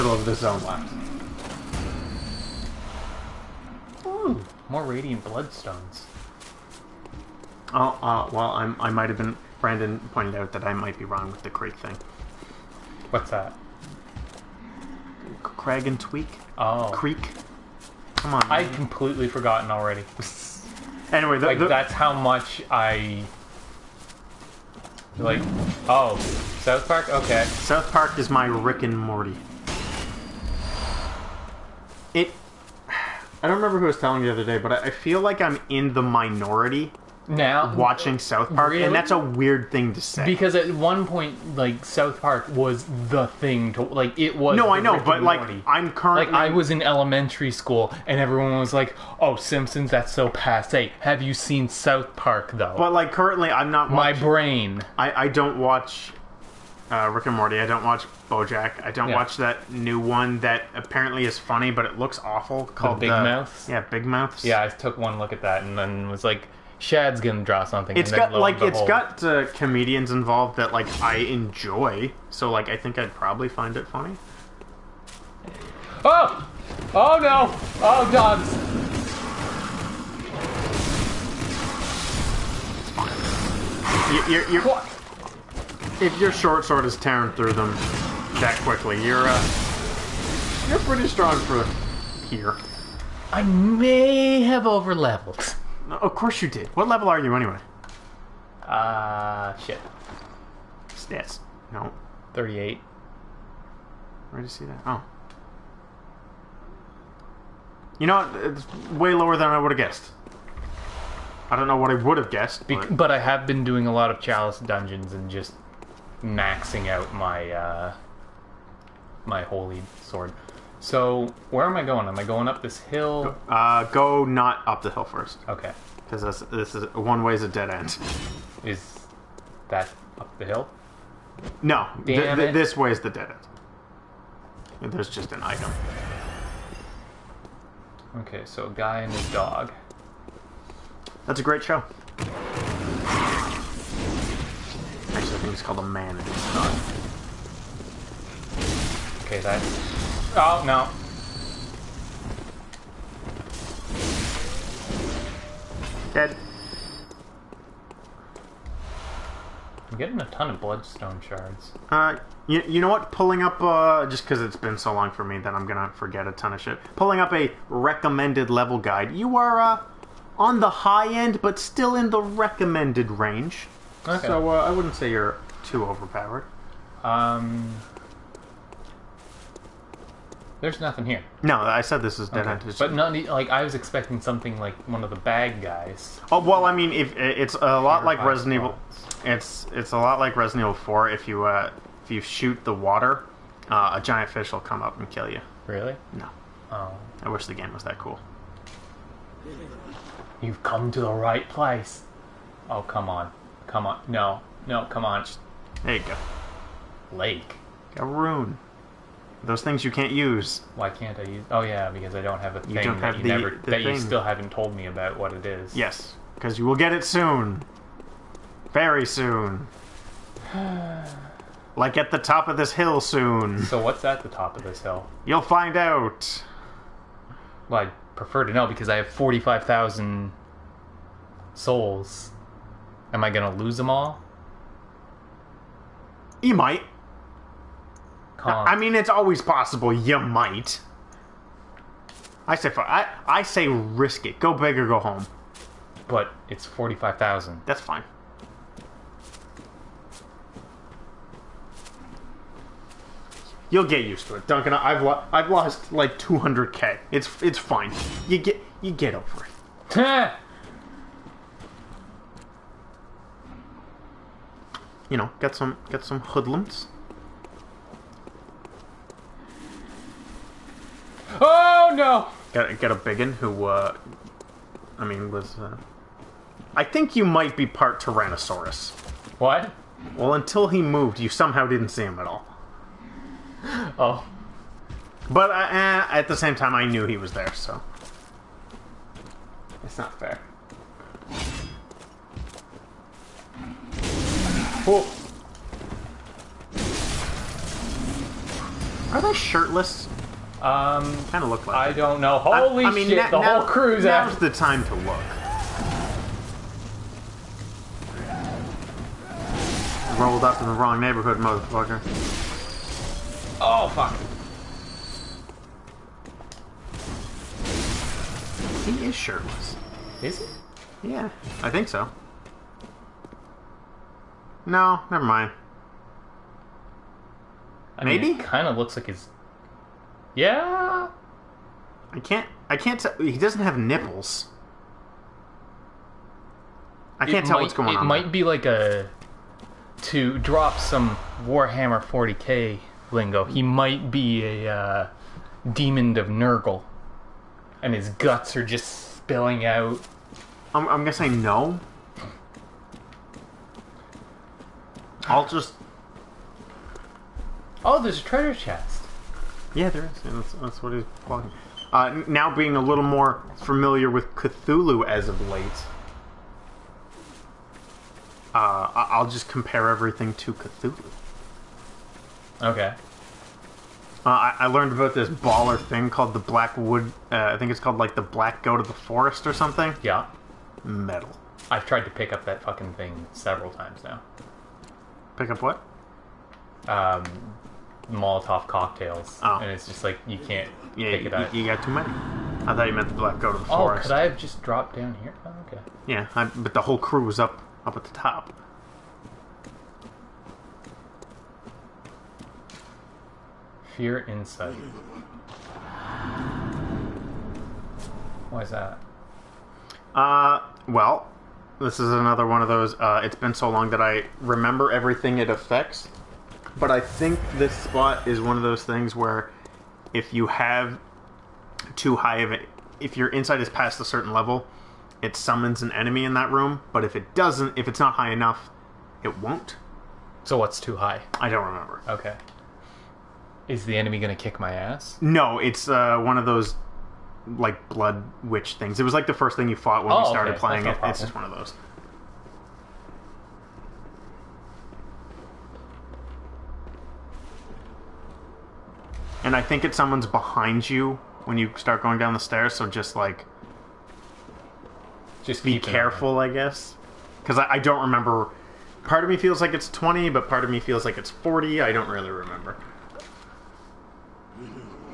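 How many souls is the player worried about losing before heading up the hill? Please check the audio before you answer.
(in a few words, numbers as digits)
45,000.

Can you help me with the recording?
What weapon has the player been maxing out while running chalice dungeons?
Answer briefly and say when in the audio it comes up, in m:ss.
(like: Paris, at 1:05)
holy sword, at 1:59.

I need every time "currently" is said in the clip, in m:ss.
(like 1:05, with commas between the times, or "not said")
0:45, 0:53.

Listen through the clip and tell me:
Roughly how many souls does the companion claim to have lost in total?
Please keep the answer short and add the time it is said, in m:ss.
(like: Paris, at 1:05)
200k, at 4:16.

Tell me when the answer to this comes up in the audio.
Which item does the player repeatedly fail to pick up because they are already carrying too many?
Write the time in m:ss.
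6:28.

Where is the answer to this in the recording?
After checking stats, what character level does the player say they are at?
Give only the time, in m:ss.
1:42.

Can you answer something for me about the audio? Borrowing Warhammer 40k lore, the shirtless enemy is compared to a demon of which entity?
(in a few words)
Nurgle.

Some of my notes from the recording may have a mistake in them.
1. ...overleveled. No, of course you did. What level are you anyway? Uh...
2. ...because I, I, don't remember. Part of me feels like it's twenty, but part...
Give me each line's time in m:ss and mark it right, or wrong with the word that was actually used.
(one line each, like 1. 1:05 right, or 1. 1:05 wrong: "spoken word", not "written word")
1. 1:34 right
2. 7:37 right.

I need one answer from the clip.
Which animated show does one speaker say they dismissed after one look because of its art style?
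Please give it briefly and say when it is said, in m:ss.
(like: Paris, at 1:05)
Big Mouth, at 1:03.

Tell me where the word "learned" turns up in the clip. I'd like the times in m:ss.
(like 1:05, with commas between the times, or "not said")
6:14.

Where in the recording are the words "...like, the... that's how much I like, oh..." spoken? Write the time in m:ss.
0:21.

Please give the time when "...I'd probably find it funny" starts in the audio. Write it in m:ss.
1:12.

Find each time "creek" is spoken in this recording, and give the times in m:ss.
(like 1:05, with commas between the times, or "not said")
0:11, 0:16.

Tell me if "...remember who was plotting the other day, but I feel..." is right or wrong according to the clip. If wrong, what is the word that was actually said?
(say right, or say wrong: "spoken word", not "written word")
wrong: "telling", not "plotting".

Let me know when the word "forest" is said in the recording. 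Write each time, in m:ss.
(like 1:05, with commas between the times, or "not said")
6:18, 6:33.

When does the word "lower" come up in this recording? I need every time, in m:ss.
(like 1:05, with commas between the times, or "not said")
1:49.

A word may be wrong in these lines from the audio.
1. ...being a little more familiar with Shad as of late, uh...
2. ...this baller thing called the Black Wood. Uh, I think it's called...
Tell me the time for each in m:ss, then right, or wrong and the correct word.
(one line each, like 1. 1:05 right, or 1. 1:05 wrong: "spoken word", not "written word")
1. 6:02 wrong: "Cthulhu", not "Shad"
2. 6:15 right.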